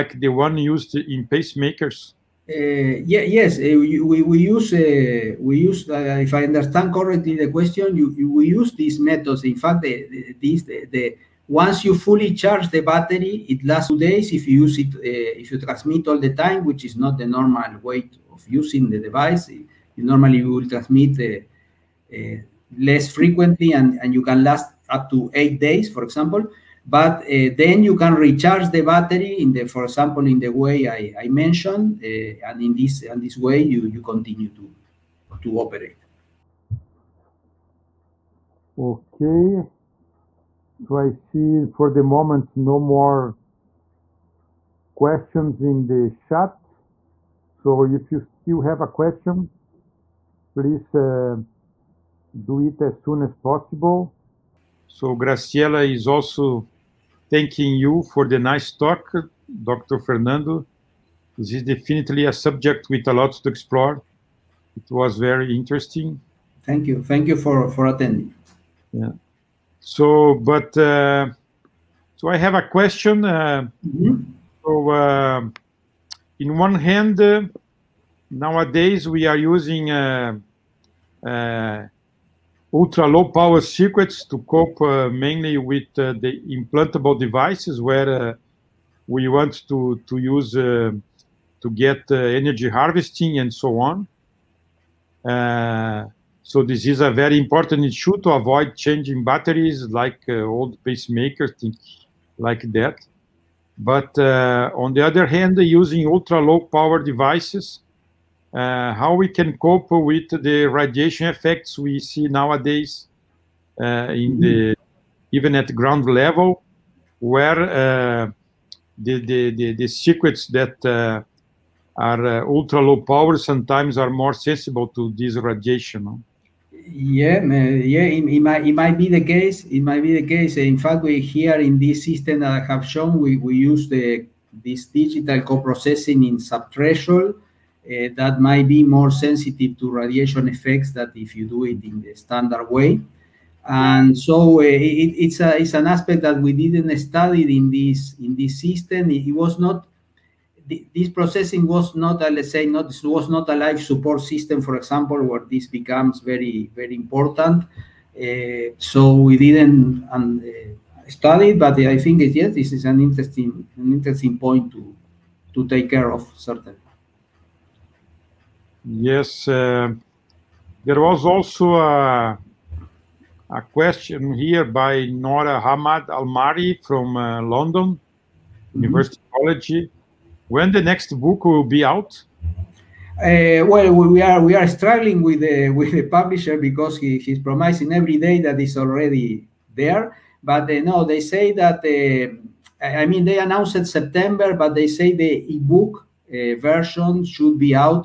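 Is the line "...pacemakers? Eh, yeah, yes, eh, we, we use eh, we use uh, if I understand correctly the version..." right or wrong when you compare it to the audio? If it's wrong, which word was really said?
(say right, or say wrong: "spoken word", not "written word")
wrong: "question", not "version".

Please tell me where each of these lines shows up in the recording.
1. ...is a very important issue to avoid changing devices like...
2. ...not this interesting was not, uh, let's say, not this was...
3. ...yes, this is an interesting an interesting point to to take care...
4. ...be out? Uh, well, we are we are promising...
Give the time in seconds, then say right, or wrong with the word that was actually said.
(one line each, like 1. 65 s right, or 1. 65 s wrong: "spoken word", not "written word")
1. 96 s wrong: "batteries", not "devices"
2. 149 s wrong: "processing", not "interesting"
3. 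162 s right
4. 181 s wrong: "struggling", not "promising".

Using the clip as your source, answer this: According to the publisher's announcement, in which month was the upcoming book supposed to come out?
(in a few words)
September.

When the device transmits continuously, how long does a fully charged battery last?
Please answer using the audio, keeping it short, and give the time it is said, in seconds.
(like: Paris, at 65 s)
2 days, at 13 s.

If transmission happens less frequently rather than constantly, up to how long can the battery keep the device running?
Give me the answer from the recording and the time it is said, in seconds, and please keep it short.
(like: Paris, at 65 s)
8 days, at 25 s.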